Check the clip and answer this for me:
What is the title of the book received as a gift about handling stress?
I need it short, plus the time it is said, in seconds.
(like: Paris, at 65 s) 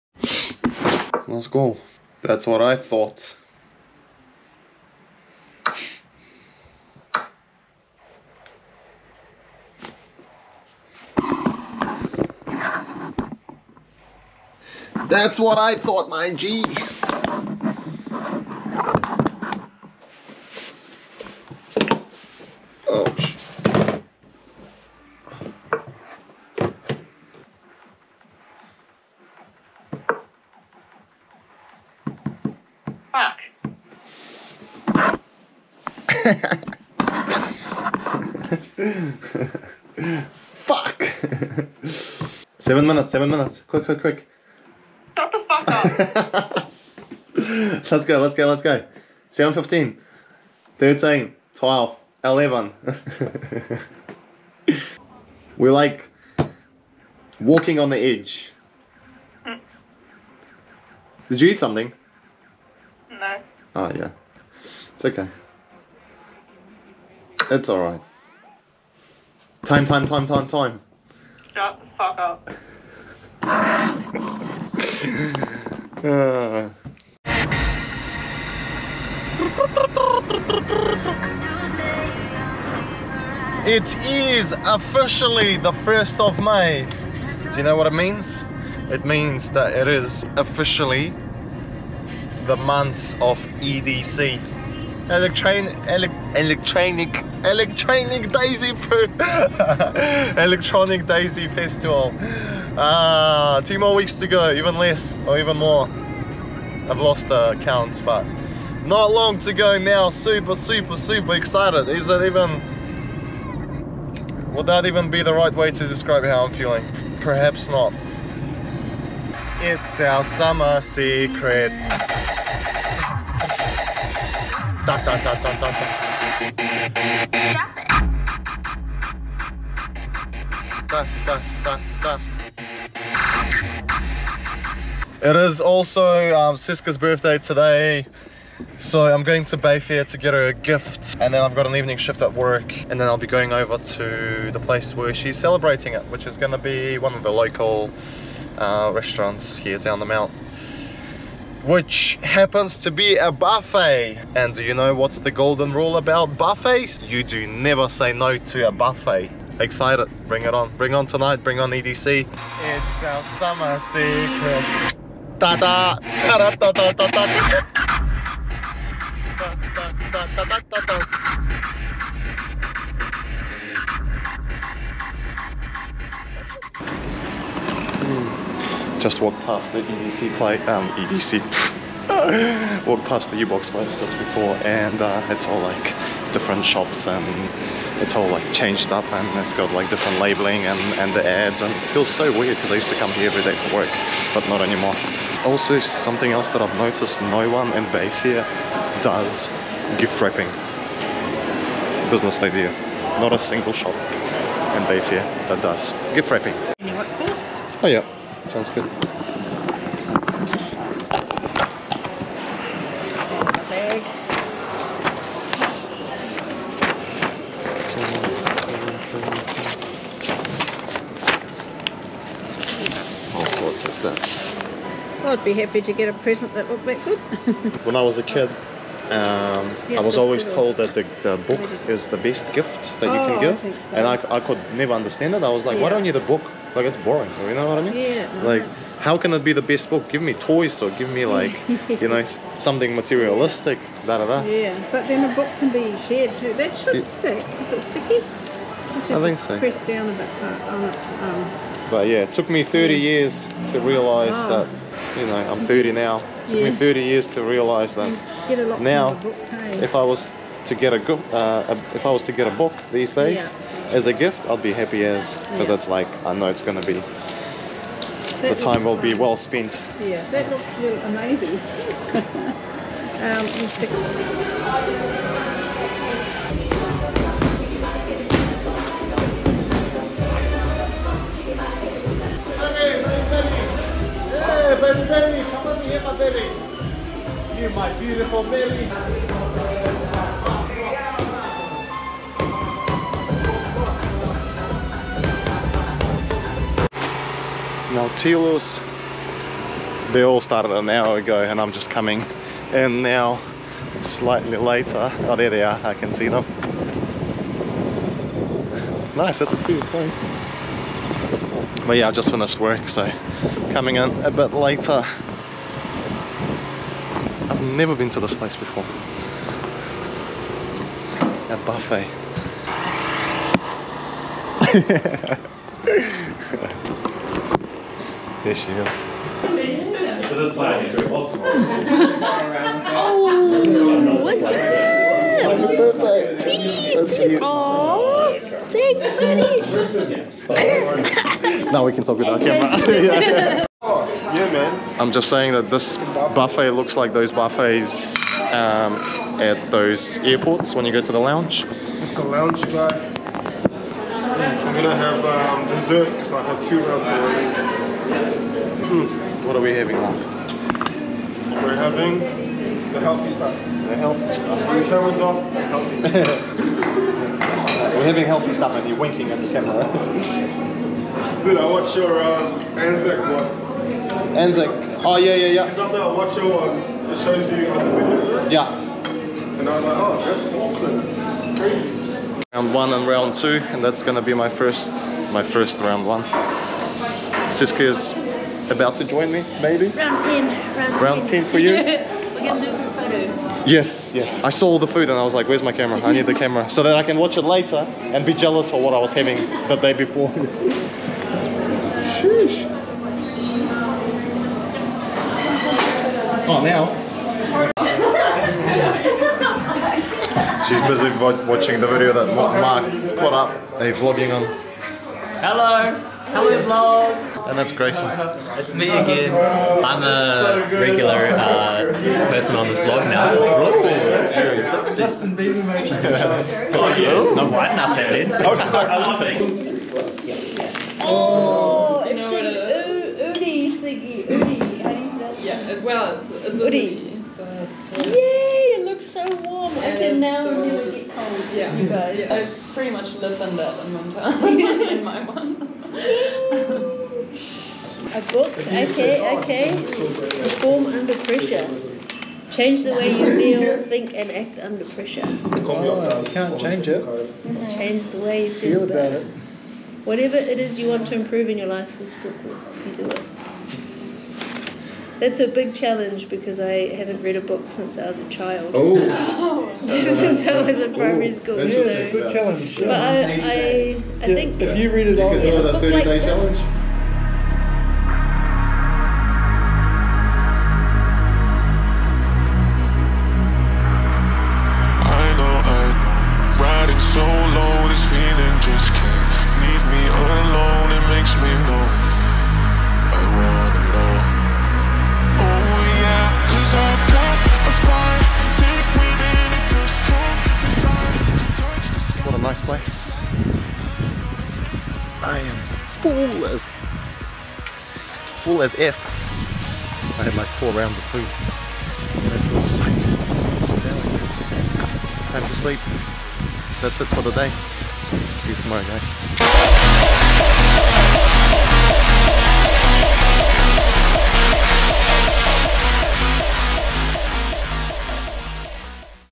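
Perform Under Pressure, at 450 s.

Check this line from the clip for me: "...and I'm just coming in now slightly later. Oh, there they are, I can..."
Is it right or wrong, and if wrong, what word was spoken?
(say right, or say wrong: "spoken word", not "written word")
right.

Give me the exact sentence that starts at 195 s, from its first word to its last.
Also something else that I've noticed no one in Bay here does gift wrapping.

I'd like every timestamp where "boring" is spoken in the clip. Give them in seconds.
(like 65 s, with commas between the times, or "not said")
236 s.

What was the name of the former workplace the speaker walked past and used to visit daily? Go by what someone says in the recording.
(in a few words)
U-Box.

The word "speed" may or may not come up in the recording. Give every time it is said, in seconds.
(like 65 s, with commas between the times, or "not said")
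not said.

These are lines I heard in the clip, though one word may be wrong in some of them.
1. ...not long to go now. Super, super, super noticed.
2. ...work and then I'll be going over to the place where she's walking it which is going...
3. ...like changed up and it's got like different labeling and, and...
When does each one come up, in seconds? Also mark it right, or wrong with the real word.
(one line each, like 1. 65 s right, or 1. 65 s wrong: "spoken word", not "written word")
1. 108 s wrong: "excited", not "noticed"
2. 142 s wrong: "celebrating", not "walking"
3. 188 s right.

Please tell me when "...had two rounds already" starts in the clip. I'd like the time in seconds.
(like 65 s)
356 s.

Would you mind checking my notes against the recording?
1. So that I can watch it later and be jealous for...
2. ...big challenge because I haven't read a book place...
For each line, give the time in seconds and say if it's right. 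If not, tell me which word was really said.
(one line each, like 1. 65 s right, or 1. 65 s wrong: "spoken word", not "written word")
1. 396 s right
2. 465 s wrong: "since", not "place".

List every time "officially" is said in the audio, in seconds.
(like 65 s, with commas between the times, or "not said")
84 s, 90 s.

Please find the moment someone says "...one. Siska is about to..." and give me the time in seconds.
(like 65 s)
386 s.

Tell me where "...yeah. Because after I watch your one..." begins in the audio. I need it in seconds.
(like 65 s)
375 s.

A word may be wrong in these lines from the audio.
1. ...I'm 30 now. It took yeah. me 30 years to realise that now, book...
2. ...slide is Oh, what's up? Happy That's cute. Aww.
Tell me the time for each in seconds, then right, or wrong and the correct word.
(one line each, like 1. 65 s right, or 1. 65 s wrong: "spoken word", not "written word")
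1. 255 s right
2. 330 s right.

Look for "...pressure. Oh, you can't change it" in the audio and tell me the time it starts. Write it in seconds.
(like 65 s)
454 s.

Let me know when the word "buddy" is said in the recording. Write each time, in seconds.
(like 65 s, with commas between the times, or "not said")
341 s.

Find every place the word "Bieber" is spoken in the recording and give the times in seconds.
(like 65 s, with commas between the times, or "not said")
425 s.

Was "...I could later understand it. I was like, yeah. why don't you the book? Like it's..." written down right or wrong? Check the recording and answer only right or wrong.
wrong.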